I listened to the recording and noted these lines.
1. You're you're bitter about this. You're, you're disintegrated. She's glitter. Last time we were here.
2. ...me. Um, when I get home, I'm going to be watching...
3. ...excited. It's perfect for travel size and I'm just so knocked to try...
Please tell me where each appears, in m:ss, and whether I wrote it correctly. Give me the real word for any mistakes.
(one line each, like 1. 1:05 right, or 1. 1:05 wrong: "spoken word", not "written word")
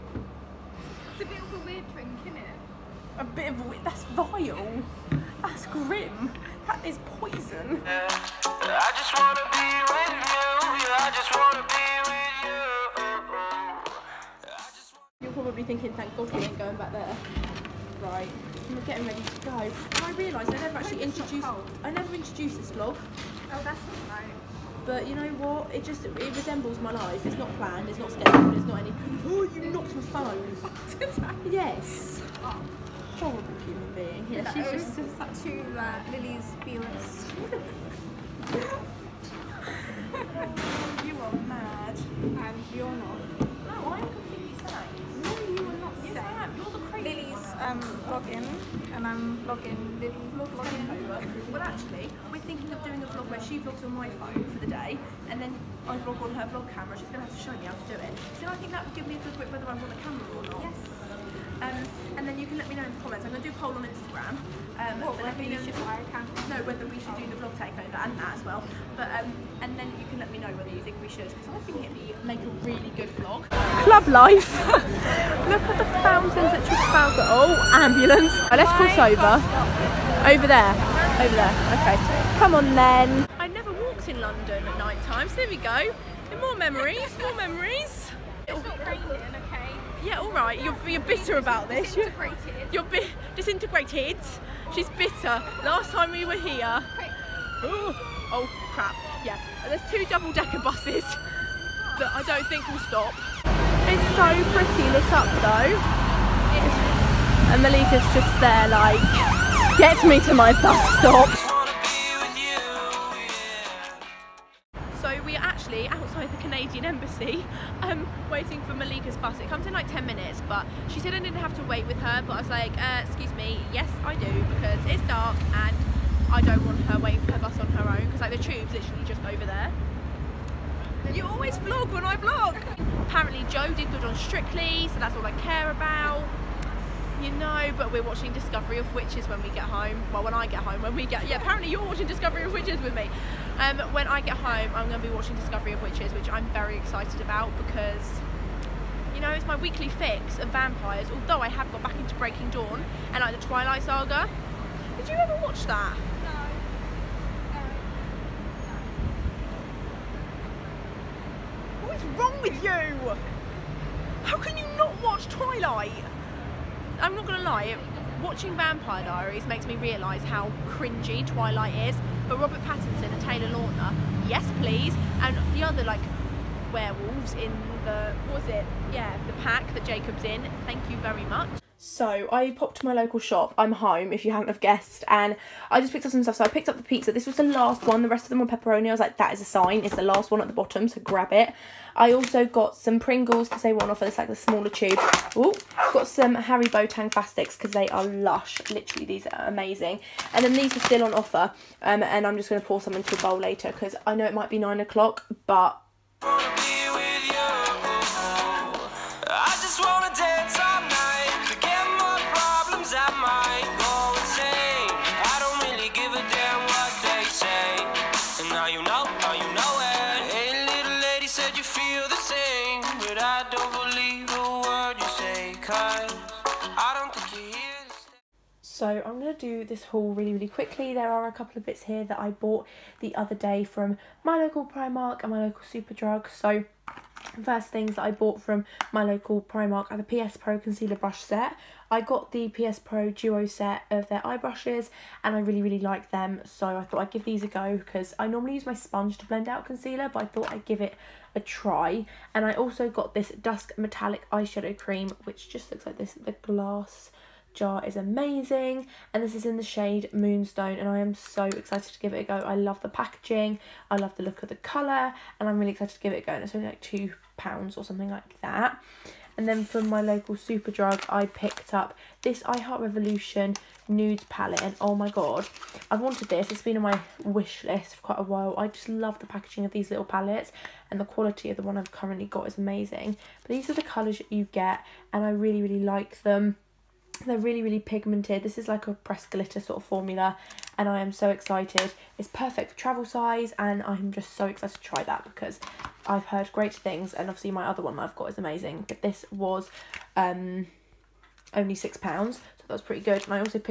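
1. 1:30 wrong: "bitter", not "glitter"
2. 2:22 right
3. 4:51 wrong: "excited", not "knocked".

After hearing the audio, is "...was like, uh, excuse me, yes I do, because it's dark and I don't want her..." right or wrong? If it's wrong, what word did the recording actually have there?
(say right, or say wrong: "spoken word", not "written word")
right.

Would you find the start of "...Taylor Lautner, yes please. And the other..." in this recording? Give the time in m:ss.
2:53.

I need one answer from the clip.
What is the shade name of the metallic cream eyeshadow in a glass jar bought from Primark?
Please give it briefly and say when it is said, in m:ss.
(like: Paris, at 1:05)
Moonstone, at 4:20.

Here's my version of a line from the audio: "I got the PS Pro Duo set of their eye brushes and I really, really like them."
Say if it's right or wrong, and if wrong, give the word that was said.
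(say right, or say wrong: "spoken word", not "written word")
right.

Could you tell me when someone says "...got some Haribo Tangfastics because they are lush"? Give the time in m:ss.
3:15.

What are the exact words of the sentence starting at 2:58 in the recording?
Yeah, the pack that Jacob's in.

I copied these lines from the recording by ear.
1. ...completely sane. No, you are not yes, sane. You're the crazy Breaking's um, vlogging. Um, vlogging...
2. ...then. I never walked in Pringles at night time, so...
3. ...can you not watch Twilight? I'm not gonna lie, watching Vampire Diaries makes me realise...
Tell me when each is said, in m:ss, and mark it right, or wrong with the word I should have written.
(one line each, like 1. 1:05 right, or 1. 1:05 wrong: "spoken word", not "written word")
1. 0:44 wrong: "Lily", not "Breaking"
2. 1:22 wrong: "London", not "Pringles"
3. 2:44 right.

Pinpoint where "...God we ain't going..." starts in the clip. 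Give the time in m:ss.
0:16.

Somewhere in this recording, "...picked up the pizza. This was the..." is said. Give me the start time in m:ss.
3:06.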